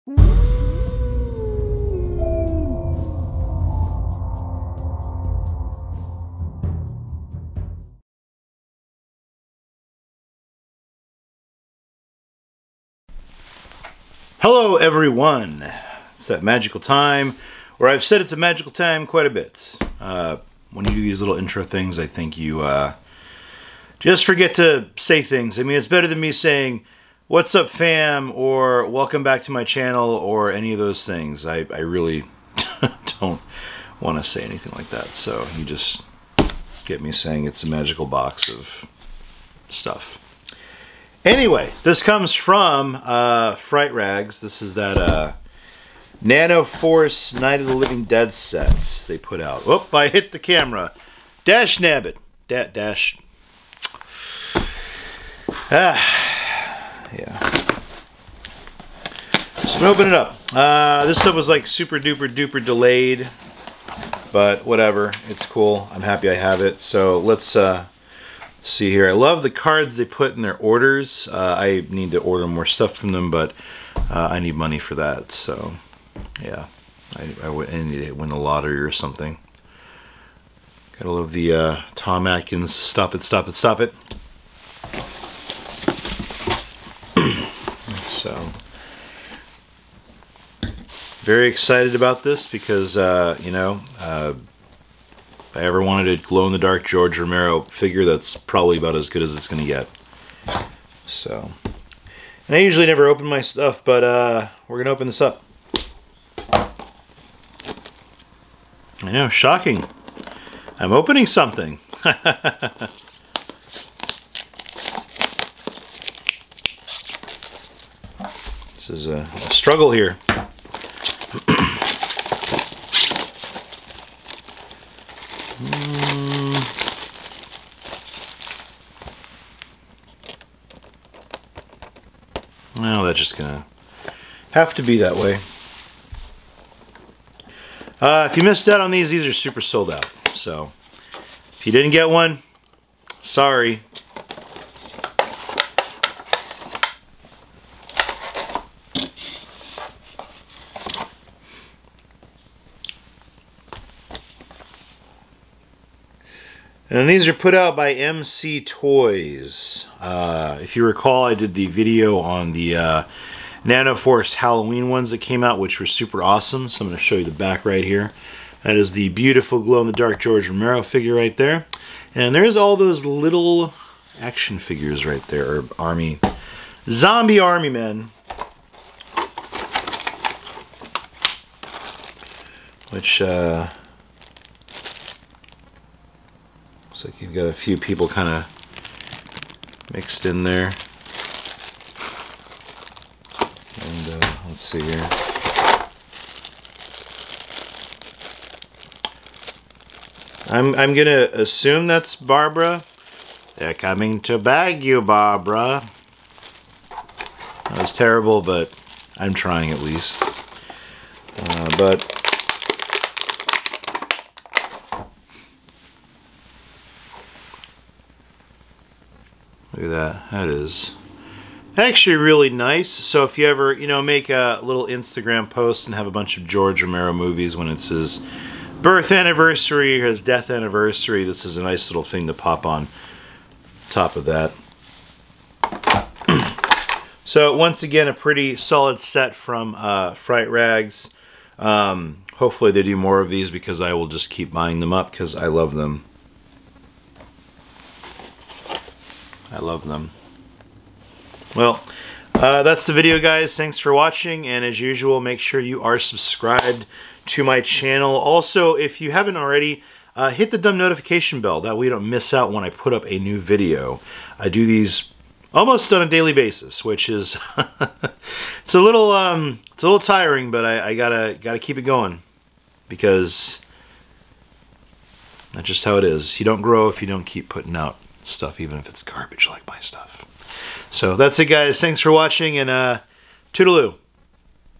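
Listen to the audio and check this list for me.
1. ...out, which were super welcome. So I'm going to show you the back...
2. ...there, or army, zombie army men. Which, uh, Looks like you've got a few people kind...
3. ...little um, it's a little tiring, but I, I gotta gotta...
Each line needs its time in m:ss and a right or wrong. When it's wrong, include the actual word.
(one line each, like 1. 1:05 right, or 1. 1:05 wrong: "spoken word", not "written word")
1. 2:45 wrong: "awesome", not "welcome"
2. 2:55 right
3. 4:28 right.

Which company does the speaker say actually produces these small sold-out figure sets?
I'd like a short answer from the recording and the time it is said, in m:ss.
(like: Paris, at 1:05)
EMCE Toys, at 2:37.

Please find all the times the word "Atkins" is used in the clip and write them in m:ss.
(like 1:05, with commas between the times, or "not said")
1:22.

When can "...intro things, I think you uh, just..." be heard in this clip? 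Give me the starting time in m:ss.
0:21.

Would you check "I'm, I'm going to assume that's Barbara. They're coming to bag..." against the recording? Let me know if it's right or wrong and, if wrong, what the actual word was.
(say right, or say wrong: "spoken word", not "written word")
right.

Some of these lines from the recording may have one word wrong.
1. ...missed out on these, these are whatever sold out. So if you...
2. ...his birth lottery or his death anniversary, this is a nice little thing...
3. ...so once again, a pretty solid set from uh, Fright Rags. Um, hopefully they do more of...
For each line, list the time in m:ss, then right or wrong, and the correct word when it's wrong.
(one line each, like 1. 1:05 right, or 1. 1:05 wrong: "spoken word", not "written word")
1. 2:18 wrong: "super", not "whatever"
2. 3:47 wrong: "anniversary", not "lottery"
3. 3:57 right.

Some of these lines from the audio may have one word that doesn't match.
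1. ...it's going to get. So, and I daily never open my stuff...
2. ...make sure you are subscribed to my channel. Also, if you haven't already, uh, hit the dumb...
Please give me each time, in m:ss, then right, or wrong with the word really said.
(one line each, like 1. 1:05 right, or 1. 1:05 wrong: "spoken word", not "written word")
1. 1:39 wrong: "usually", not "daily"
2. 4:15 right.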